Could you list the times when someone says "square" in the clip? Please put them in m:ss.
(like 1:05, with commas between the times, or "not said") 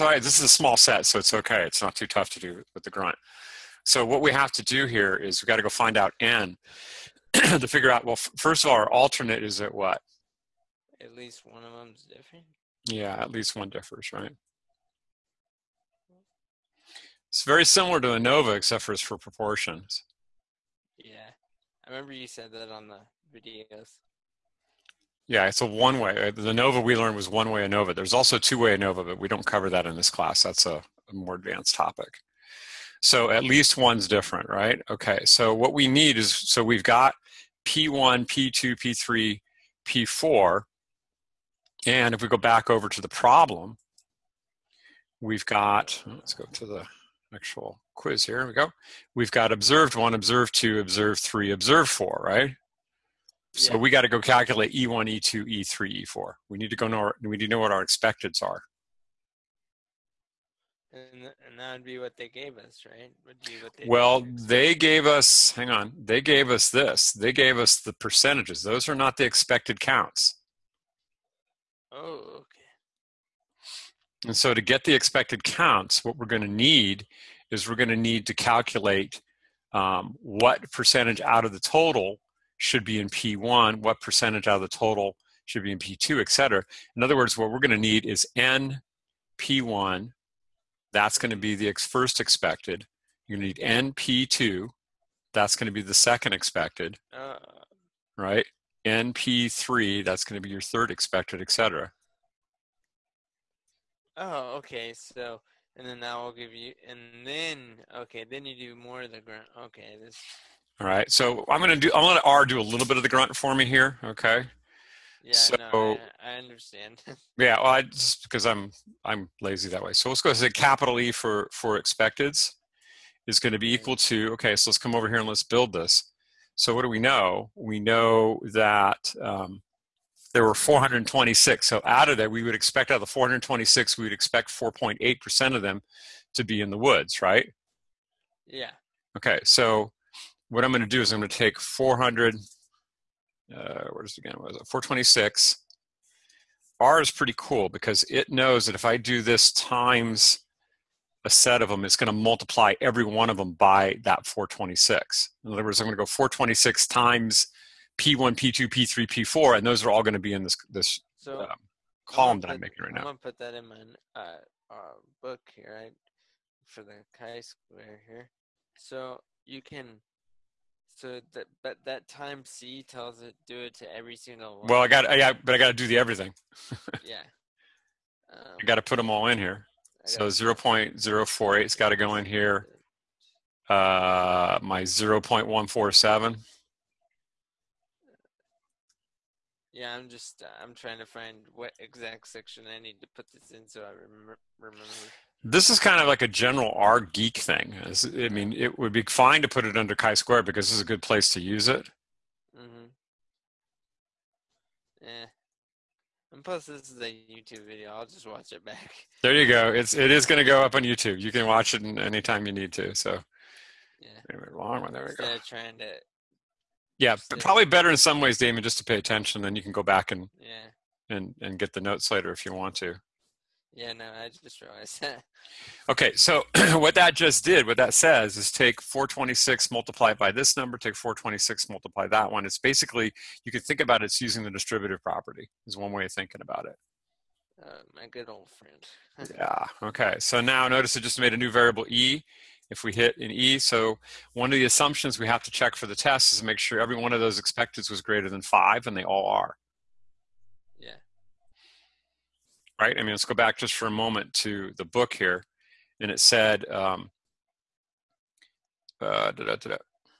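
2:47, 3:19.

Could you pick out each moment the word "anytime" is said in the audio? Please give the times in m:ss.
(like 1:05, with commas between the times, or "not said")
3:31.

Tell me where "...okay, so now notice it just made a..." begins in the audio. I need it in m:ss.
3:59.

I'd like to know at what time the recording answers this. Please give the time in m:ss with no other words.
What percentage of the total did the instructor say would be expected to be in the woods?
2:14.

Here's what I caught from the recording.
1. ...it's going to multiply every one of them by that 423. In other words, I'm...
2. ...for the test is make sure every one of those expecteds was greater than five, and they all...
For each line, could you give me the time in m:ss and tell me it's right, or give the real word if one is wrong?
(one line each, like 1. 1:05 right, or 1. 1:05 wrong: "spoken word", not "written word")
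1. 2:31 wrong: "426", not "423"
2. 4:05 right.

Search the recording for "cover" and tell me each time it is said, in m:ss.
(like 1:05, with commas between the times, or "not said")
0:29.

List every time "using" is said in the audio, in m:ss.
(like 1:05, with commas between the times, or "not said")
3:54.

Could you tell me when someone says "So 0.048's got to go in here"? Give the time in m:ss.
3:00.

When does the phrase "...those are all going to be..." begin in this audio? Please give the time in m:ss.
2:39.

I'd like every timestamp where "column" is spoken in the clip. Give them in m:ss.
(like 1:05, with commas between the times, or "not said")
2:42.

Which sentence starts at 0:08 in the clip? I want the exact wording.
Well, first of all, our alternate is at what?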